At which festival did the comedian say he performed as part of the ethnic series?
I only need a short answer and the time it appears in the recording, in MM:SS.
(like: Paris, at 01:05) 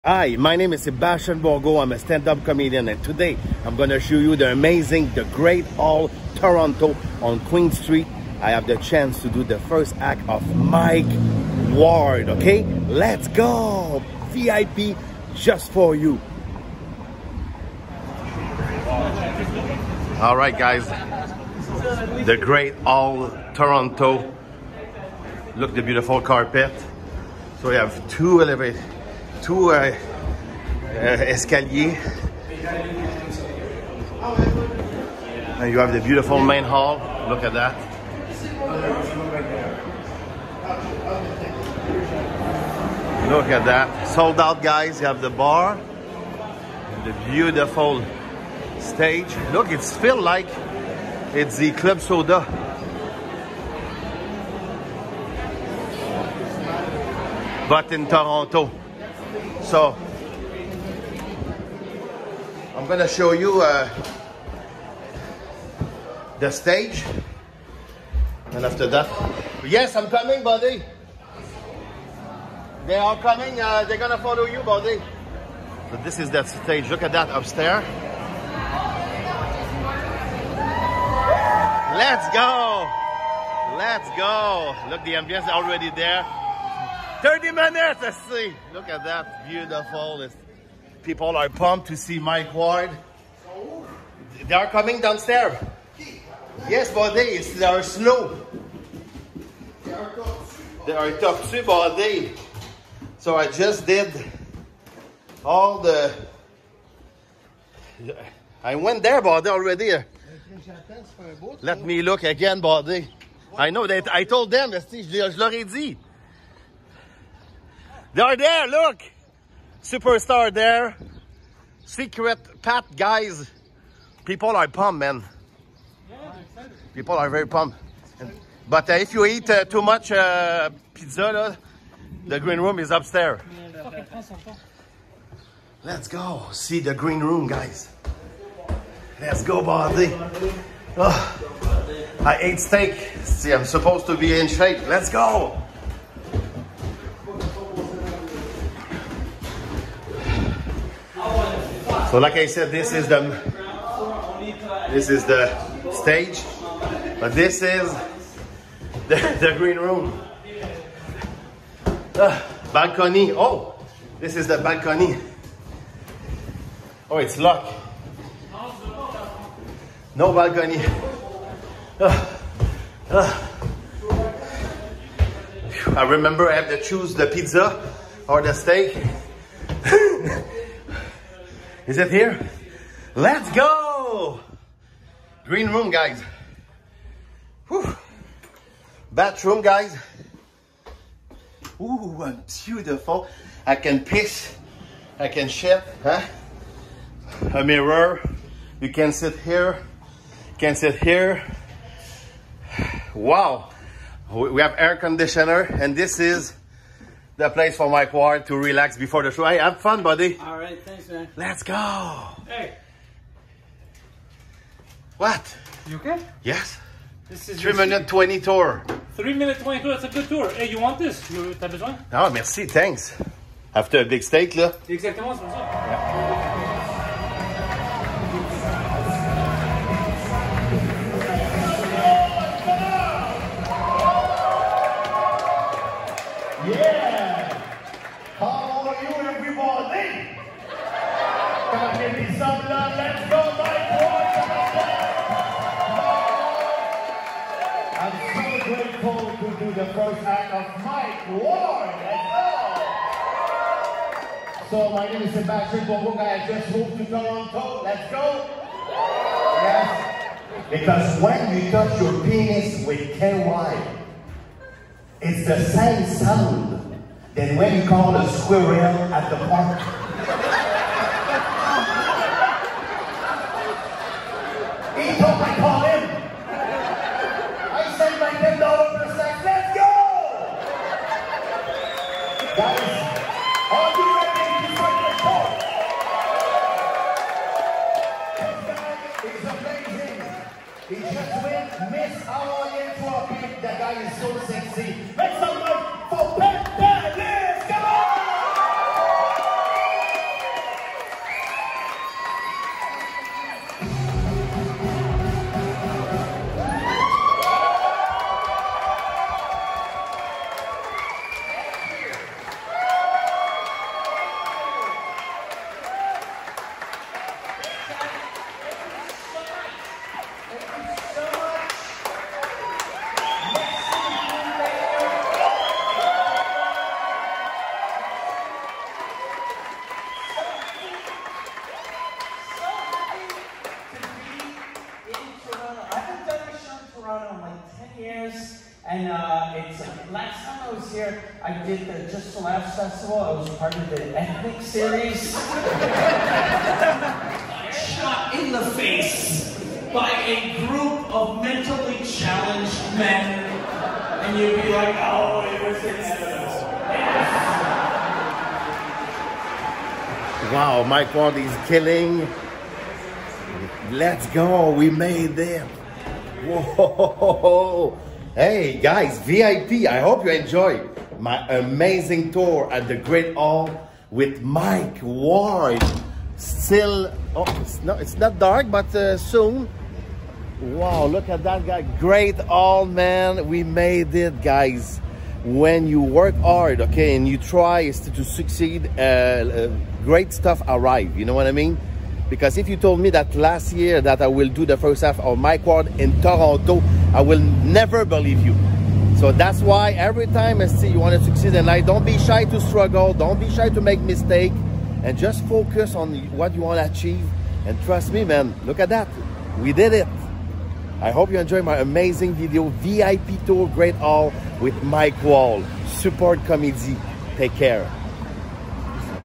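Just the Laughs Festival, at 05:42.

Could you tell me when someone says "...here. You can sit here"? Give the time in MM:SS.
03:19.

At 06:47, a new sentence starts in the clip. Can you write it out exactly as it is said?
And trust me, man, look at that.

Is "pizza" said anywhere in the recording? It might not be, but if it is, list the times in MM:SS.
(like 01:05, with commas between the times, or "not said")
02:10, 02:57.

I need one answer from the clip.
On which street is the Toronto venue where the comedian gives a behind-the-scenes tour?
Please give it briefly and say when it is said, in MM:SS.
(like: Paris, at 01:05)
Queen Street, at 00:07.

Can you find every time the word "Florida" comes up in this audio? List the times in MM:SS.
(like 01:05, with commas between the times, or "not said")
not said.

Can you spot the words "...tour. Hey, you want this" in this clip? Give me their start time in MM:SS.
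03:40.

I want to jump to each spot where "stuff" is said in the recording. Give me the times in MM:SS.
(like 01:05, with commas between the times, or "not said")
06:30.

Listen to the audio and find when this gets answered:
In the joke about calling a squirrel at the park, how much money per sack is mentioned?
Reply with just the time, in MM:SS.
04:38.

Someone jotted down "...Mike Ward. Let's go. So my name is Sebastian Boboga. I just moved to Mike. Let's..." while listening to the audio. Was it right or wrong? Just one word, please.
wrong.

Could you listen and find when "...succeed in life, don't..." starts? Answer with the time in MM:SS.
06:41.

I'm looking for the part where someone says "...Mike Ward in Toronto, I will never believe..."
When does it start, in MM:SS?
06:35.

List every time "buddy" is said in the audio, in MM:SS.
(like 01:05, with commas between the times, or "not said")
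01:10, 01:14, 01:36, 01:41, 01:52, 03:30.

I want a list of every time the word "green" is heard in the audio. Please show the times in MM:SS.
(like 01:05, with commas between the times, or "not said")
02:12, 02:16, 02:39, 03:05.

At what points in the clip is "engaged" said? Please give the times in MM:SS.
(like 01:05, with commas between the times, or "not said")
not said.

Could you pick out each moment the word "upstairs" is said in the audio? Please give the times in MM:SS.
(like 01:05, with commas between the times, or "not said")
01:17, 02:12.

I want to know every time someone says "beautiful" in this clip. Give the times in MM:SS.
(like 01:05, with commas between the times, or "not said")
00:25, 00:36, 00:47, 01:29, 03:12.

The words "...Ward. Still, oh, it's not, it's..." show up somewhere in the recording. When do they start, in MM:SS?
06:15.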